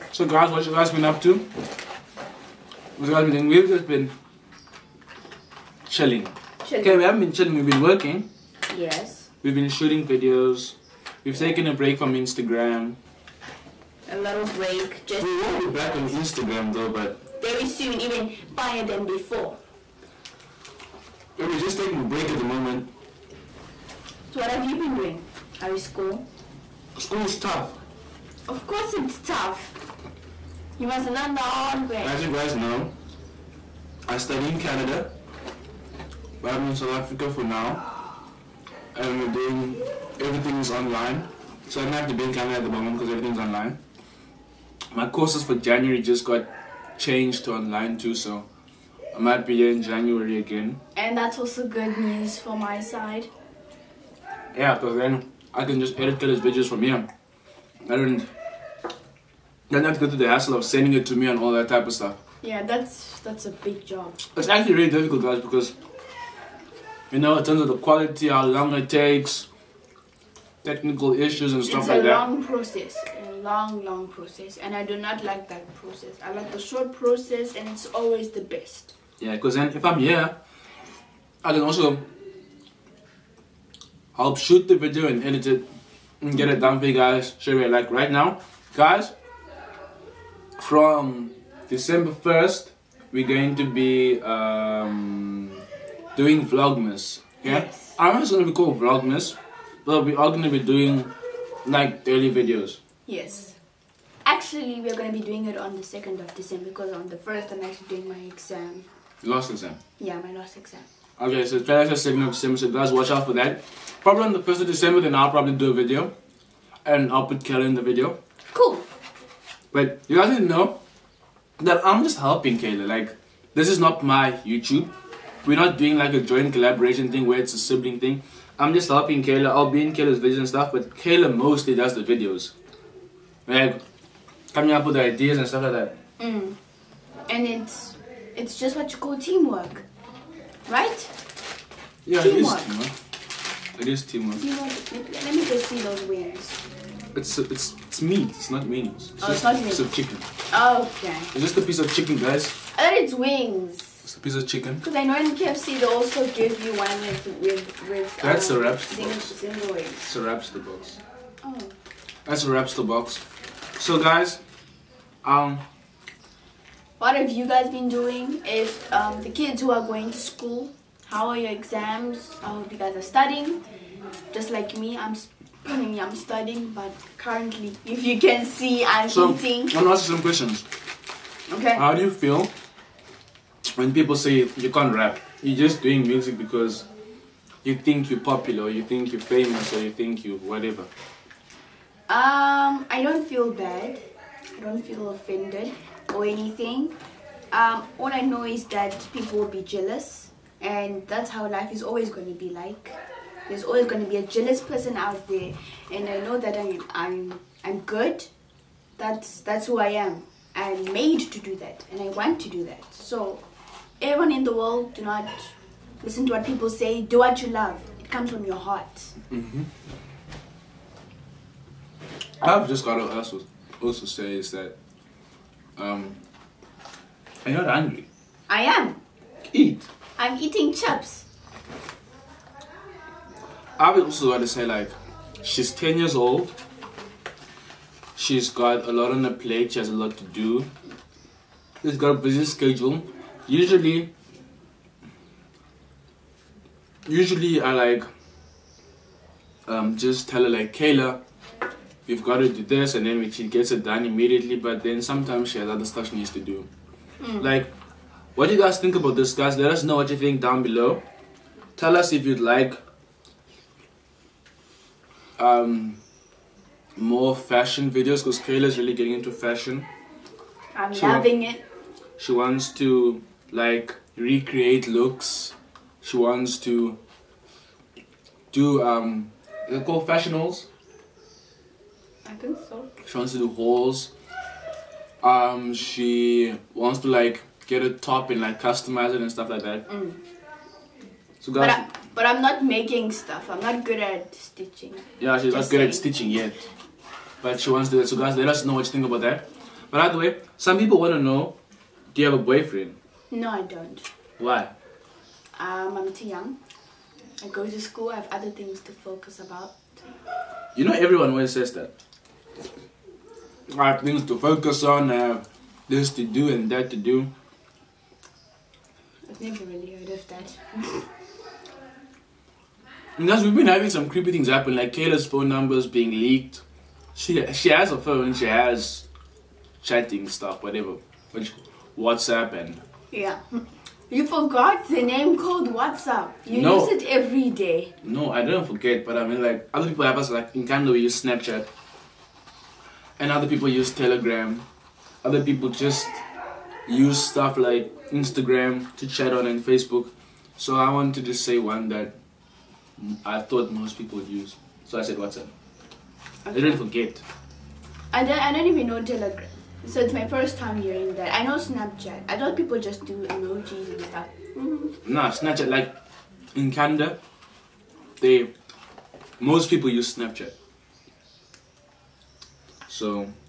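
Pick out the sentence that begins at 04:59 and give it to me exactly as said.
But by the way, some people want to know, do you have a boyfriend?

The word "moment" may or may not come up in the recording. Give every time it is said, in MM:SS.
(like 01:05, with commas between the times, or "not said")
00:22, 00:42.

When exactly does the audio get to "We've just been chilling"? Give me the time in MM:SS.
00:03.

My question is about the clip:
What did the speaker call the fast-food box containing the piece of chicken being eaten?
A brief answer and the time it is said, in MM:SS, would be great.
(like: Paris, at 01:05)
wrapster box, at 02:42.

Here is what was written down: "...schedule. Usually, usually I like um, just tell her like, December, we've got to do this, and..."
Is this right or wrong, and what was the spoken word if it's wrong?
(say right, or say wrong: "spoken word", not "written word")
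wrong: "Kayla", not "December".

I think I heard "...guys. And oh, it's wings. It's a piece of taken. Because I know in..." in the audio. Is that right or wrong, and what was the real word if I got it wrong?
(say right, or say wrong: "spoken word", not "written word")
wrong: "chicken", not "taken".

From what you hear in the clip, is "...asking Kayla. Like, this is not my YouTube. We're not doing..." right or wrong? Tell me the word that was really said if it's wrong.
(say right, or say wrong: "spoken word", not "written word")
wrong: "helping", not "asking".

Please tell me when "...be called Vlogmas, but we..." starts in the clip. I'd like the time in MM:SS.
01:38.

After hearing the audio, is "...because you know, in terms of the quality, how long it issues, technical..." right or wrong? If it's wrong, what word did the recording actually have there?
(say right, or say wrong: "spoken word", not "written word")
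wrong: "takes", not "issues".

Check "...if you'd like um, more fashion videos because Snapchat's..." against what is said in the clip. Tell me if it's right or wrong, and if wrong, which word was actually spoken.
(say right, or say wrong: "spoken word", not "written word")
wrong: "Kayla", not "Snapchat".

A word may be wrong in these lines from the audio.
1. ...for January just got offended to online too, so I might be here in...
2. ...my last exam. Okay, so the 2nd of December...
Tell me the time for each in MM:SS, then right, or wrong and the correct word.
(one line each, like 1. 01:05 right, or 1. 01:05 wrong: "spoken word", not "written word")
1. 00:45 wrong: "changed", not "offended"
2. 01:50 right.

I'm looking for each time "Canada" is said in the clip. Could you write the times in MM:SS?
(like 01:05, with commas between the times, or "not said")
00:34, 00:42, 05:40, 06:06.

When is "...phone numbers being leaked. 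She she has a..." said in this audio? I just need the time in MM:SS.
05:25.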